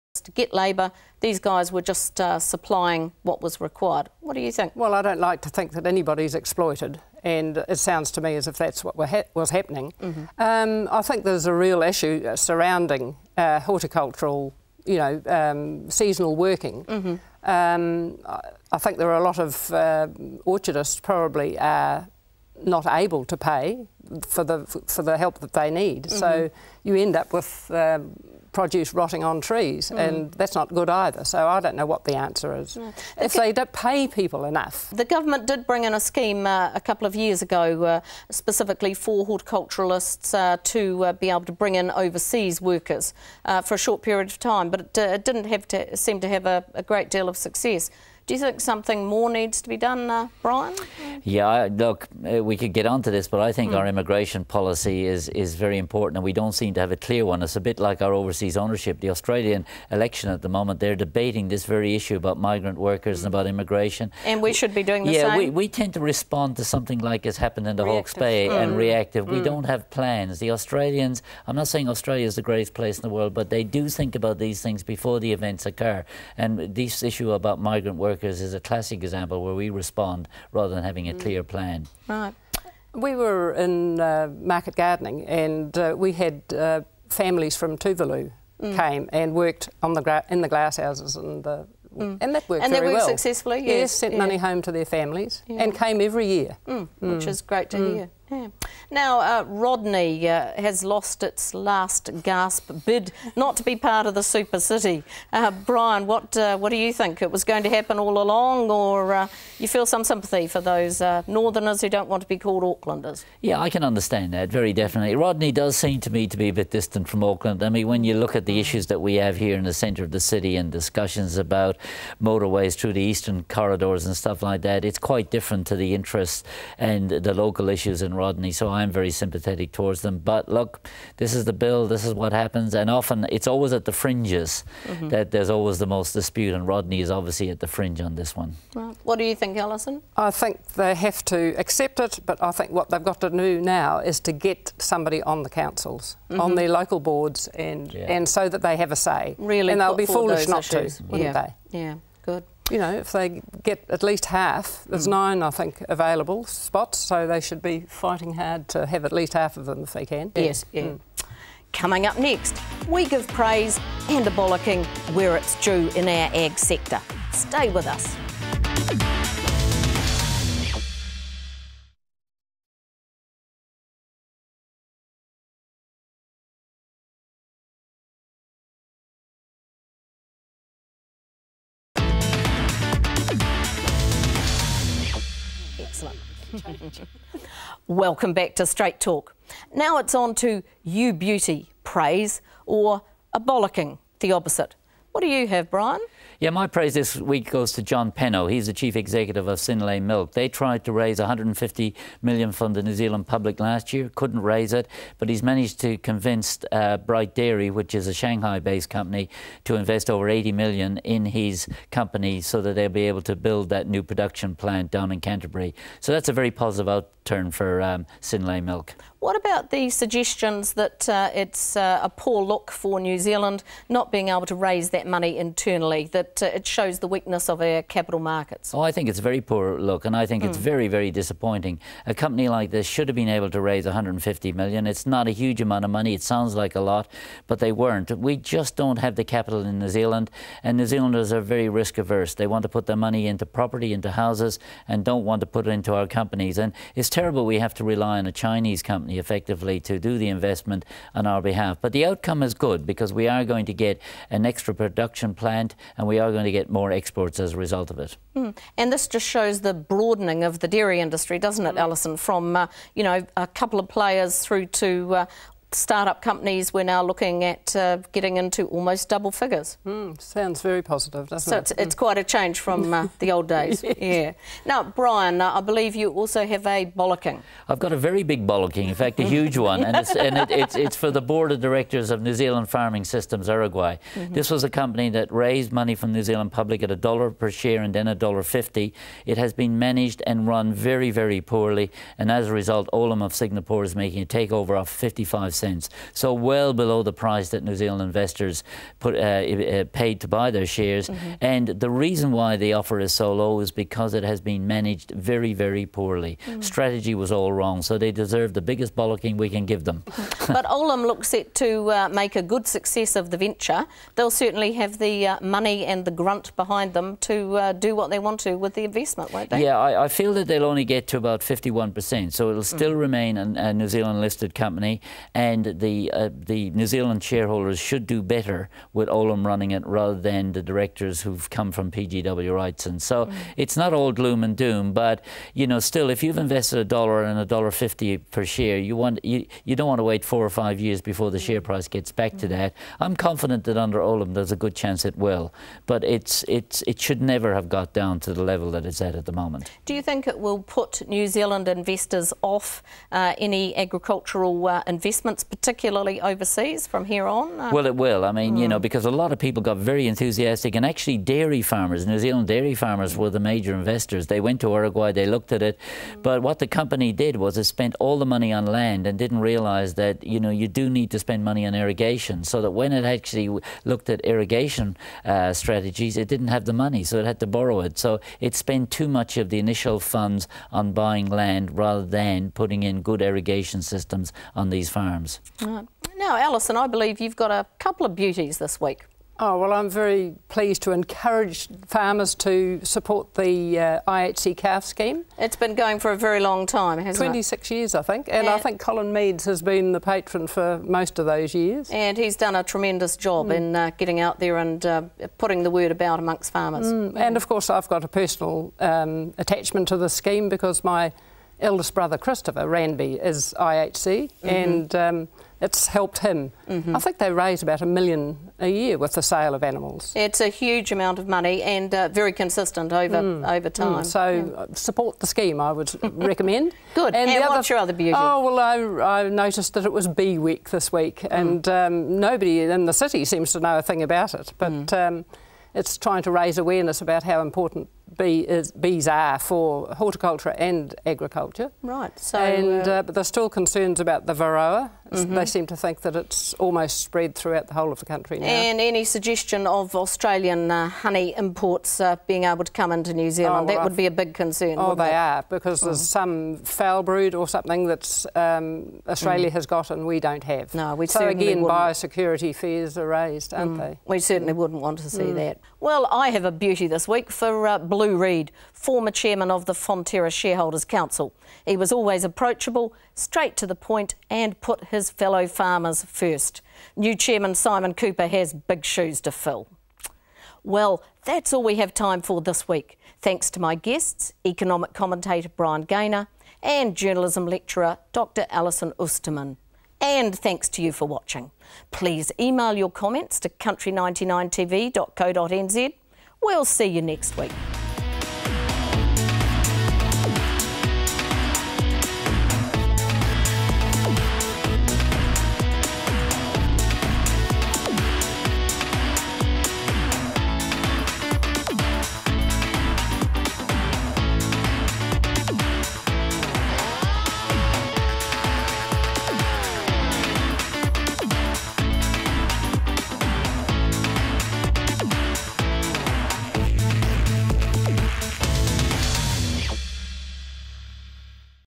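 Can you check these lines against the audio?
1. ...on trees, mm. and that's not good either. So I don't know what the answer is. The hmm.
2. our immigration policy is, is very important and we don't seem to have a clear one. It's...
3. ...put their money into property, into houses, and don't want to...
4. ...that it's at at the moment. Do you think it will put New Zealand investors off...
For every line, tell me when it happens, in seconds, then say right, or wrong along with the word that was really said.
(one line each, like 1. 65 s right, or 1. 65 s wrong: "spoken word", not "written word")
1. 29 s right
2. 53 s right
3. 242 s right
4. 348 s right.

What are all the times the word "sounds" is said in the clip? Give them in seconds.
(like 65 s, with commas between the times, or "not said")
7 s, 236 s, 270 s.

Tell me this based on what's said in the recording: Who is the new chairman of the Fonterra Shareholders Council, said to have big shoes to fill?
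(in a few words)
Simon Couper.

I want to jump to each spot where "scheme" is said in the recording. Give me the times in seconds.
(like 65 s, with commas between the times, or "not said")
35 s, 394 s, 410 s, 425 s.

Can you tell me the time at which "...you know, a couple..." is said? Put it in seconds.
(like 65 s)
262 s.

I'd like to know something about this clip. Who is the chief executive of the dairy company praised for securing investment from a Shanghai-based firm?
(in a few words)
John Penno.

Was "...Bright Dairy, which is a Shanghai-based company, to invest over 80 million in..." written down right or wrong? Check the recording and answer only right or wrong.
right.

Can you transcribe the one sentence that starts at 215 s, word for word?
So that's a very positive outcome turn for um, Synlait milk.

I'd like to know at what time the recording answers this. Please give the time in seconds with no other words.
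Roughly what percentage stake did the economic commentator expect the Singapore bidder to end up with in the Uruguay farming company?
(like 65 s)
321 s.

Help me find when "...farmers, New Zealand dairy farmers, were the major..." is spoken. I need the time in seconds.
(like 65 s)
361 s.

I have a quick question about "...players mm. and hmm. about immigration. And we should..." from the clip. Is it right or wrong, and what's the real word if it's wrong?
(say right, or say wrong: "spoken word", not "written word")
wrong: "workers", not "players".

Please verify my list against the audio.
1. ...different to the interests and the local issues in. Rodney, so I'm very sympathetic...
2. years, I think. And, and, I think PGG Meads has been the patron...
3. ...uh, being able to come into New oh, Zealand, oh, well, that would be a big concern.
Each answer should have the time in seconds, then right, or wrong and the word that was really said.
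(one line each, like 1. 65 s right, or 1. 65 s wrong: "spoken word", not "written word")
1. 125 s right
2. 397 s wrong: "Colin", not "PGG"
3. 452 s right.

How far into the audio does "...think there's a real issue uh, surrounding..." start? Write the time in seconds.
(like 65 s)
11 s.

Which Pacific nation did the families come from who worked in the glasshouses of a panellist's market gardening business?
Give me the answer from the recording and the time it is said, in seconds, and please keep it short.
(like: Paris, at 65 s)
Tuvalu, at 87 s.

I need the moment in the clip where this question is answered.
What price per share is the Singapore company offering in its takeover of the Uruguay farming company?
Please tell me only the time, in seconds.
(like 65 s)
294 s.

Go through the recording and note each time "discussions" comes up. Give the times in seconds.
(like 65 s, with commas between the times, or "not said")
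120 s.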